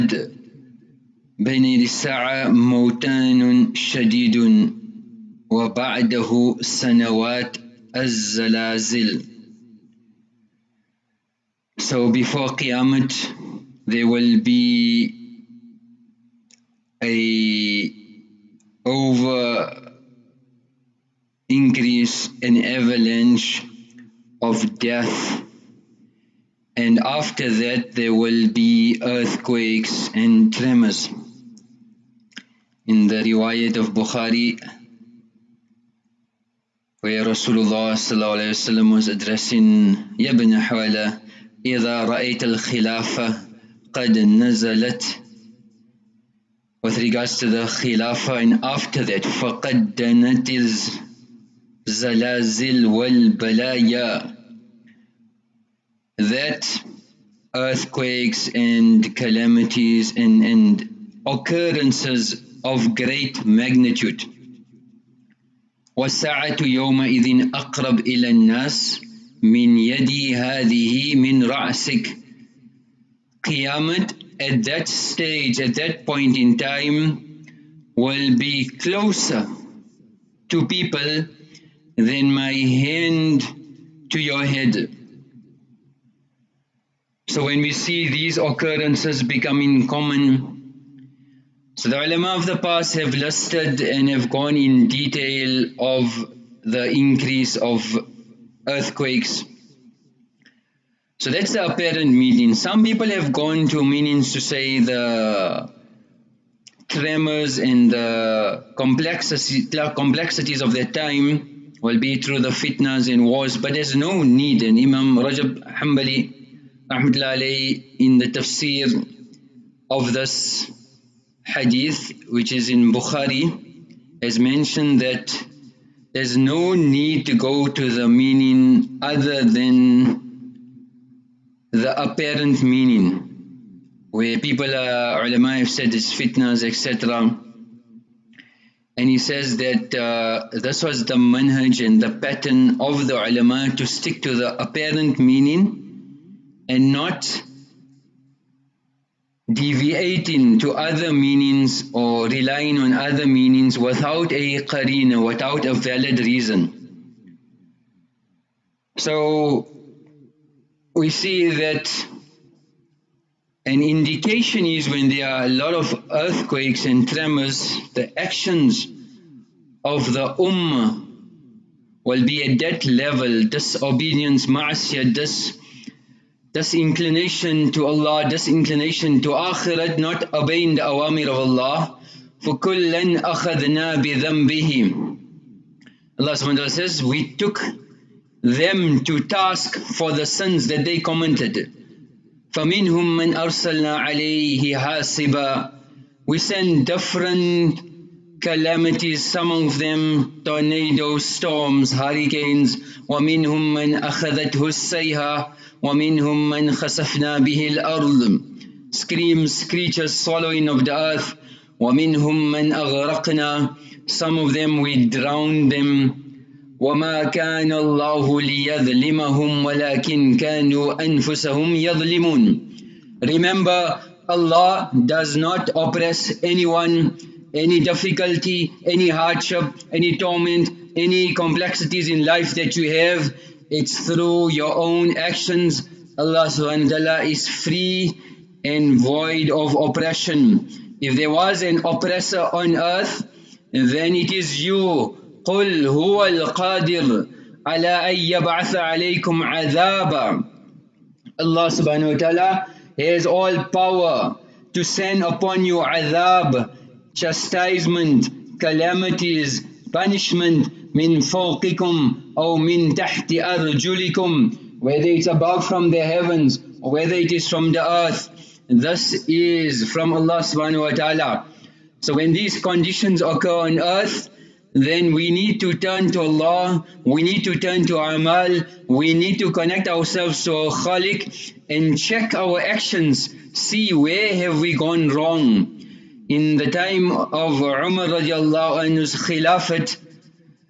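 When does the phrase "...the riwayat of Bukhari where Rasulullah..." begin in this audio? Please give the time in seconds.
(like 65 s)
33 s.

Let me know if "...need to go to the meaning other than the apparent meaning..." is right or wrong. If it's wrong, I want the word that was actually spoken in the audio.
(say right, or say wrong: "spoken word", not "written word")
right.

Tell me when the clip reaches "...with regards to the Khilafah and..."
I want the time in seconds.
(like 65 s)
46 s.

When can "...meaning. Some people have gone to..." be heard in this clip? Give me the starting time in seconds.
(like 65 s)
102 s.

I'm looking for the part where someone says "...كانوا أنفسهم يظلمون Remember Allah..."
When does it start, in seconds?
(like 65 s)
220 s.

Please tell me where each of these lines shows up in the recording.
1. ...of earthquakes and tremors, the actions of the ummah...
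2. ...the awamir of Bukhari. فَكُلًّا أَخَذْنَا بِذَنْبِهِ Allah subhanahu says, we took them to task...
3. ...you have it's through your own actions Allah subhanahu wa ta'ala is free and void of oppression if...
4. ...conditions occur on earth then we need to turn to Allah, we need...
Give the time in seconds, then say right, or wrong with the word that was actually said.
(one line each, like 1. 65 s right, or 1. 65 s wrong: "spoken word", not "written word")
1. 165 s right
2. 180 s wrong: "Allah", not "Bukhari"
3. 232 s right
4. 272 s right.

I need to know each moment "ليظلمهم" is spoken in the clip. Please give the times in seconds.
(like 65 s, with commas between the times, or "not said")
218 s.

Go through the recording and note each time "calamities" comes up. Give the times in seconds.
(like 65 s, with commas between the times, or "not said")
59 s, 198 s, 258 s.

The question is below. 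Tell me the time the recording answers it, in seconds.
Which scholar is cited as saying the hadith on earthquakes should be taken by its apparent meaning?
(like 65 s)
114 s.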